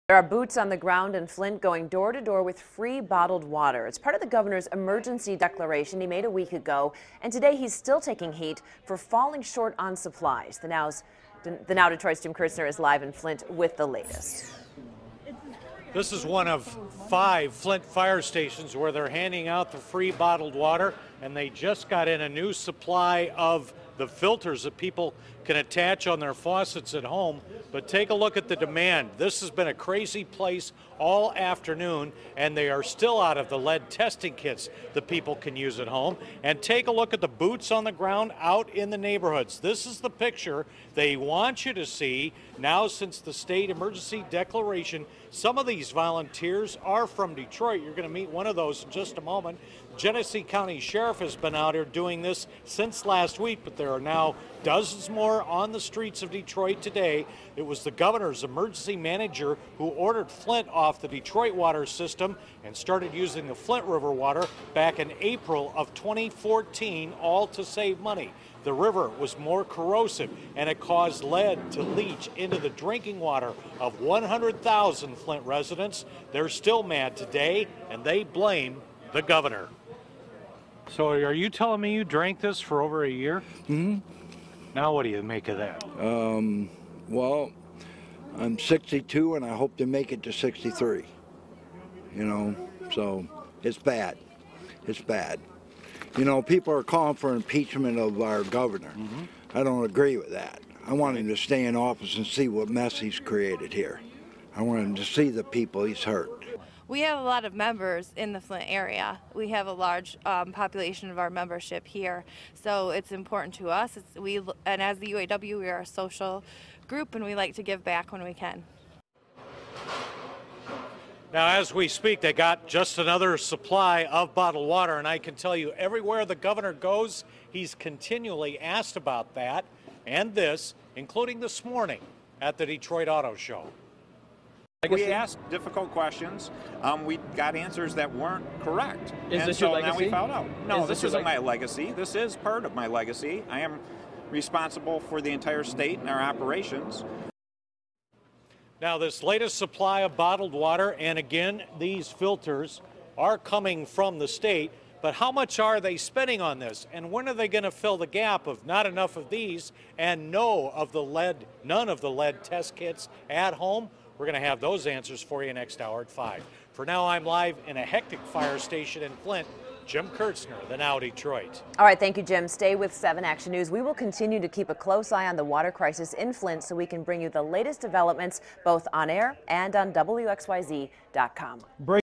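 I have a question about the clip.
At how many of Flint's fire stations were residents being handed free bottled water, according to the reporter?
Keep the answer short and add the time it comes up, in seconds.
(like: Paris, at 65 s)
5, at 17 s.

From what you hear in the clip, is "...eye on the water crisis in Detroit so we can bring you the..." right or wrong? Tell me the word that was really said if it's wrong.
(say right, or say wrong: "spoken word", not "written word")
wrong: "Flint", not "Detroit".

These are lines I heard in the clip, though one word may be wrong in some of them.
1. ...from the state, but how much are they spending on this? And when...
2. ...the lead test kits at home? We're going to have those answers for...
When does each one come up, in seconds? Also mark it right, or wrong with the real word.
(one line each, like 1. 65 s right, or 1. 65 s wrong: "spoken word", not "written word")
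1. 153 s right
2. 162 s right.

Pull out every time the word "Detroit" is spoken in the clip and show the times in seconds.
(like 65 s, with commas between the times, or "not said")
11 s, 47 s, 56 s, 61 s, 132 s, 170 s.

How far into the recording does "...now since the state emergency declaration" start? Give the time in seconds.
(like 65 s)
42 s.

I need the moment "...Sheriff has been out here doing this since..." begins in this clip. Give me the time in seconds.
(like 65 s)
50 s.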